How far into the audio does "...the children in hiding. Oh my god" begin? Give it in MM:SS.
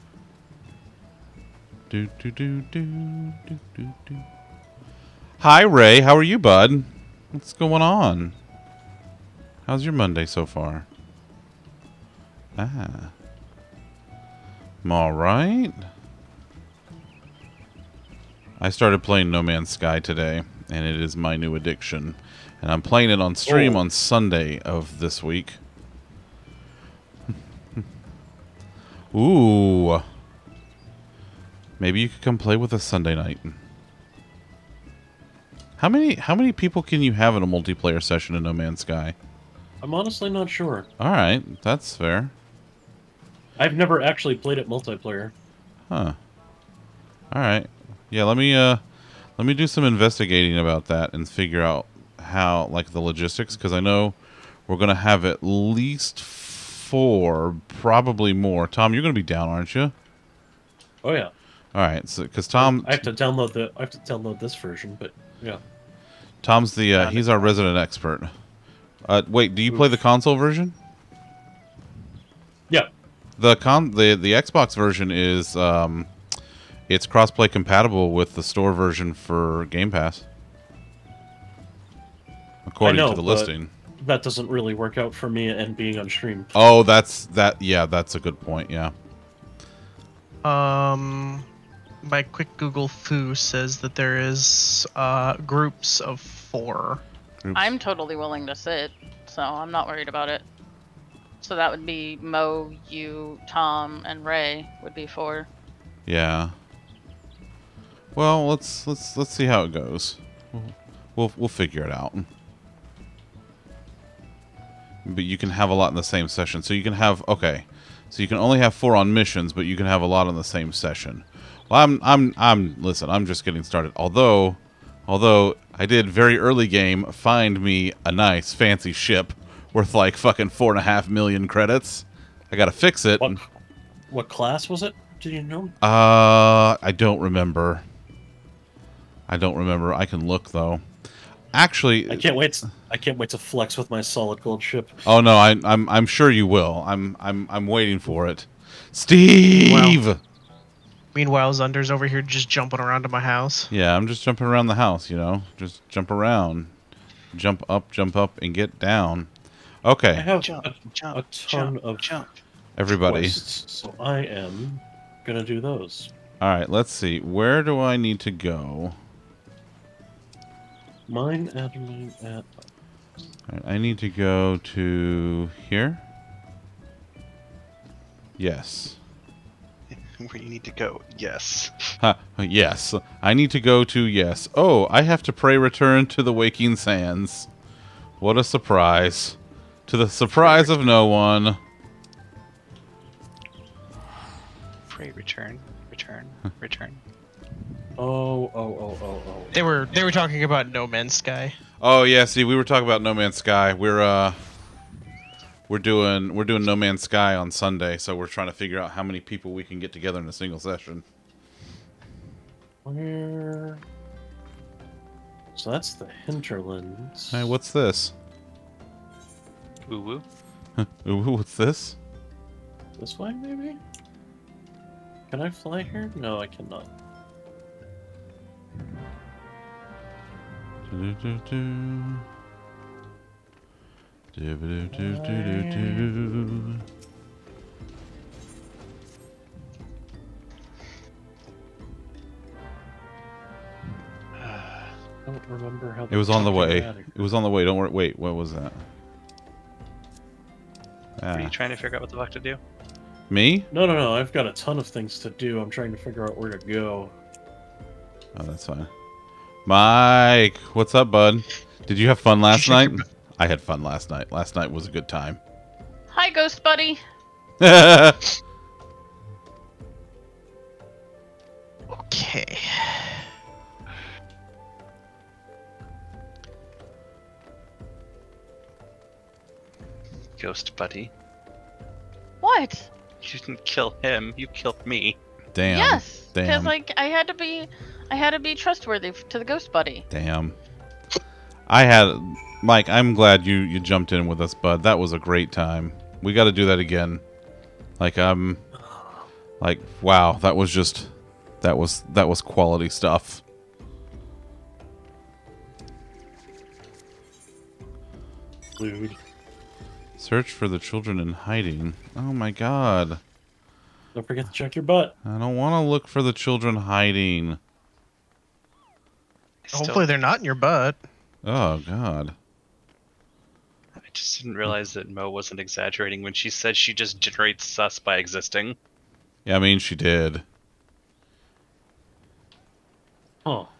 05:10.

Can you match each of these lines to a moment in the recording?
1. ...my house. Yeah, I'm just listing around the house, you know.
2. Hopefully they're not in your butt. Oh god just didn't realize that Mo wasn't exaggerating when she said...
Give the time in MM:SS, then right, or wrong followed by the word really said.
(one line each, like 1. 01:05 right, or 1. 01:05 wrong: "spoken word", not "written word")
1. 02:33 wrong: "jumping", not "listing"
2. 05:19 right.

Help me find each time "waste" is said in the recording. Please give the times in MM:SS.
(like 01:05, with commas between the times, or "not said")
not said.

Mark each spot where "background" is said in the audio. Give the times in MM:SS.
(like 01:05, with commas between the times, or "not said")
not said.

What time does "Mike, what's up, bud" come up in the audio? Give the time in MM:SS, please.
04:19.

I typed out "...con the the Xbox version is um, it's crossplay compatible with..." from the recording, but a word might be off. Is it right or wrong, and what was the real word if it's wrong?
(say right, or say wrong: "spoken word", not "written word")
right.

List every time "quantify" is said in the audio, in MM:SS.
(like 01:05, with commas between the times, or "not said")
not said.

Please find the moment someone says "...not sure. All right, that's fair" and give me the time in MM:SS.
00:40.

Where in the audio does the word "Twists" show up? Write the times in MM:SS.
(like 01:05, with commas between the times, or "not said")
02:43.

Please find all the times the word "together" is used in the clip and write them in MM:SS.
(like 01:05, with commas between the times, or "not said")
03:29.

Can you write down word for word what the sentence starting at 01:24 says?
That doesn't really work out for me and being on stream.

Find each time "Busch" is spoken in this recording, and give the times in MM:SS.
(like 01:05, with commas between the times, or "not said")
not said.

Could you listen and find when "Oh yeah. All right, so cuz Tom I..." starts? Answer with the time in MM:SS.
01:01.